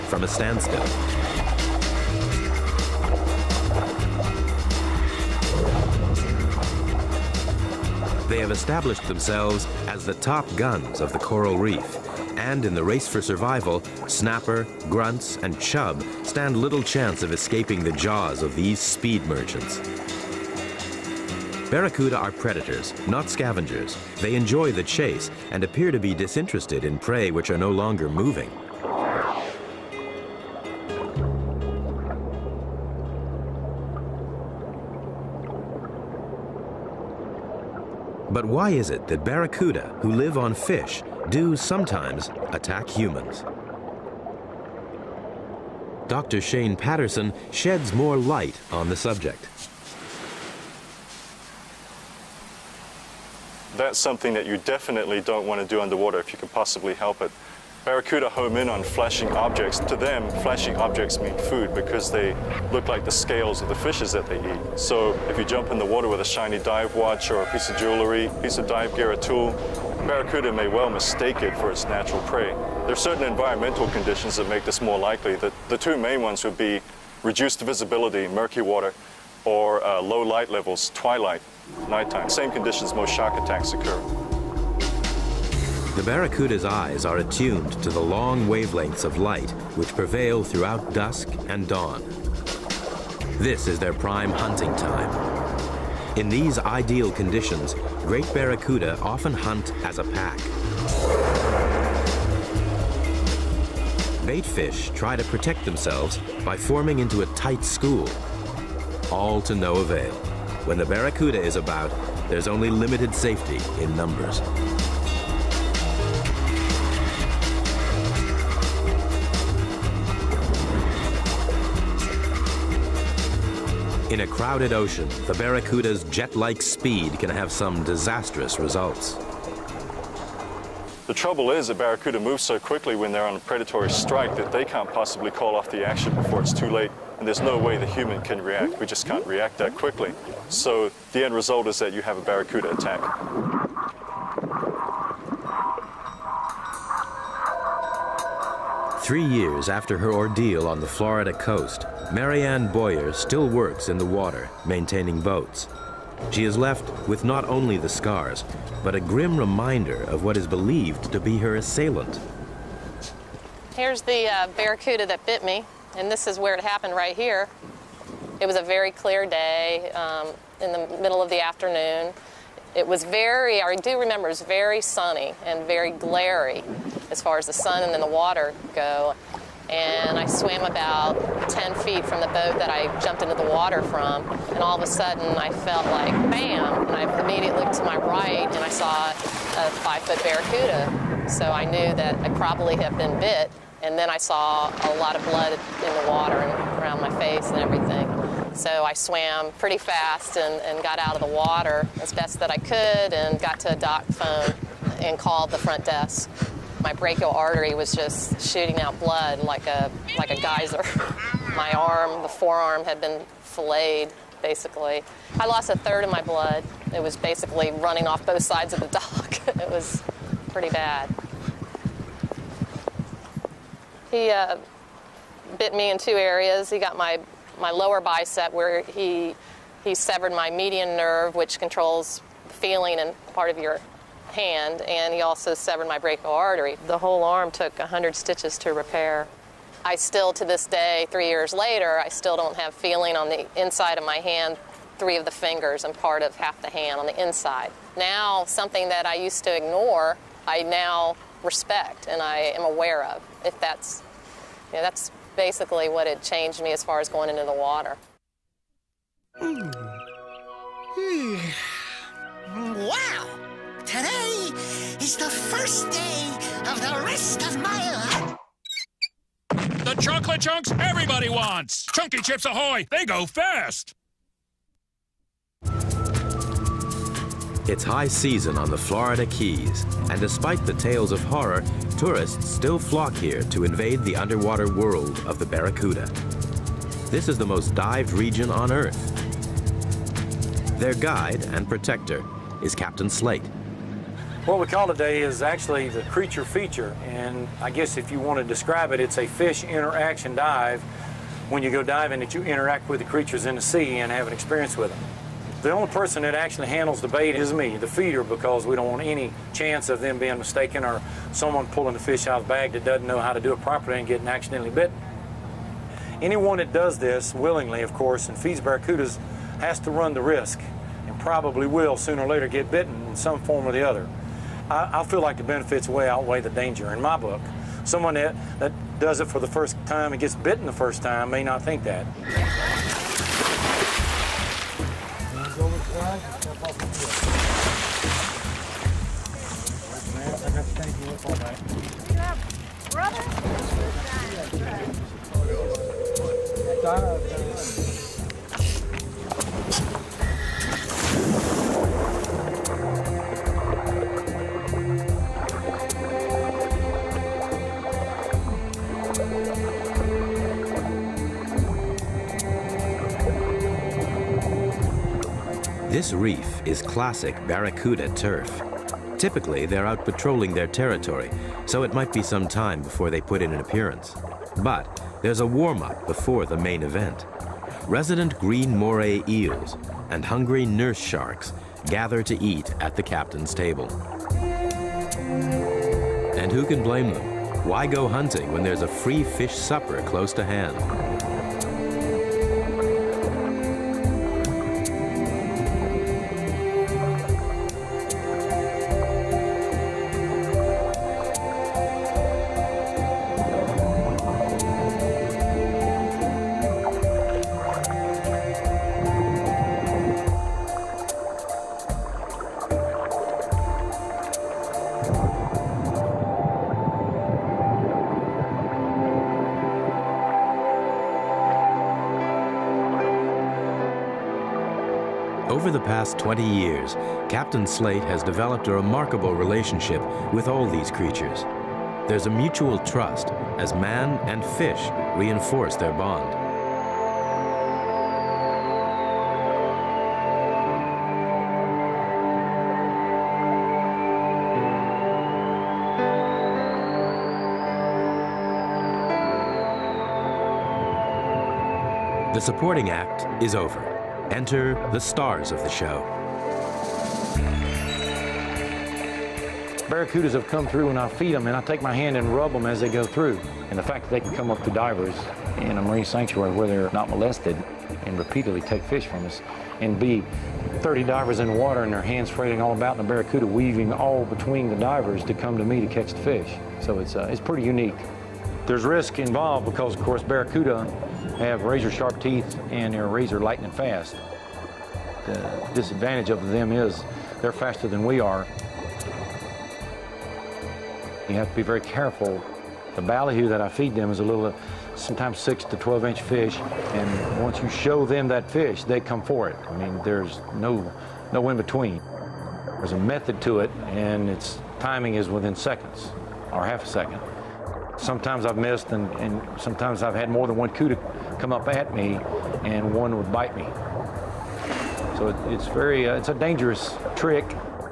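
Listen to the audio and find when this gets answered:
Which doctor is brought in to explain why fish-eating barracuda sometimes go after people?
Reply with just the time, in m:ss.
0:46.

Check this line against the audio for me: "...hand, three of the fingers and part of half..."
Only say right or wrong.
right.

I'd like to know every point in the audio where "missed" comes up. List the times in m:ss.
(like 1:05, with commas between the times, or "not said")
8:28.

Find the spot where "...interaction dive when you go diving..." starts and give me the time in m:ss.
4:59.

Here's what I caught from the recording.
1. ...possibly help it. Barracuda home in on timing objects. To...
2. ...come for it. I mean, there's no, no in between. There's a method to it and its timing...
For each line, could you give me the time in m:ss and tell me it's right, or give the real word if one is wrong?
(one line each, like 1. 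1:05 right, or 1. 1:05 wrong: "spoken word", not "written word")
1. 0:56 wrong: "flashing", not "timing"
2. 8:18 right.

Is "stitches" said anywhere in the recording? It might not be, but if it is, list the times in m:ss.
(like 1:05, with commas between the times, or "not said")
3:58.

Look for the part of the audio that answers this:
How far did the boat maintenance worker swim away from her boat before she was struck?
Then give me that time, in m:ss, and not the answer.
3:01.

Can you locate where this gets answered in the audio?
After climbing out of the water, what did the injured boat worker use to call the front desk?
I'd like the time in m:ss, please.
3:23.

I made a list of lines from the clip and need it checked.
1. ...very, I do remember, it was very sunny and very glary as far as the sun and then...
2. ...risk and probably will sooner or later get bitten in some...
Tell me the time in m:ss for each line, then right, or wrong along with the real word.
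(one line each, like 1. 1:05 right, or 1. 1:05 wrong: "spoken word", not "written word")
1. 2:53 right
2. 5:20 right.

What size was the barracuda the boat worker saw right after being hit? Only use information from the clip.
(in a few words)
5 foot.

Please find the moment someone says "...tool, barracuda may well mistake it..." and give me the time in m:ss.
1:09.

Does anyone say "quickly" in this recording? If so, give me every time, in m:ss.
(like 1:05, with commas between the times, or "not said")
2:12, 2:19.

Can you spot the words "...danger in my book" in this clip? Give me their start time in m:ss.
5:26.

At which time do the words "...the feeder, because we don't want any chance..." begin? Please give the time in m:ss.
5:07.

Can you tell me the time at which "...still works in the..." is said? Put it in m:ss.
2:33.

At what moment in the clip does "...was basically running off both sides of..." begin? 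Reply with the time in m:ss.
3:37.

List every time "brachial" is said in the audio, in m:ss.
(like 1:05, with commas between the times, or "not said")
3:26, 3:55.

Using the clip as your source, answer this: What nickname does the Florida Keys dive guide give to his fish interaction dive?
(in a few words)
Creature feature.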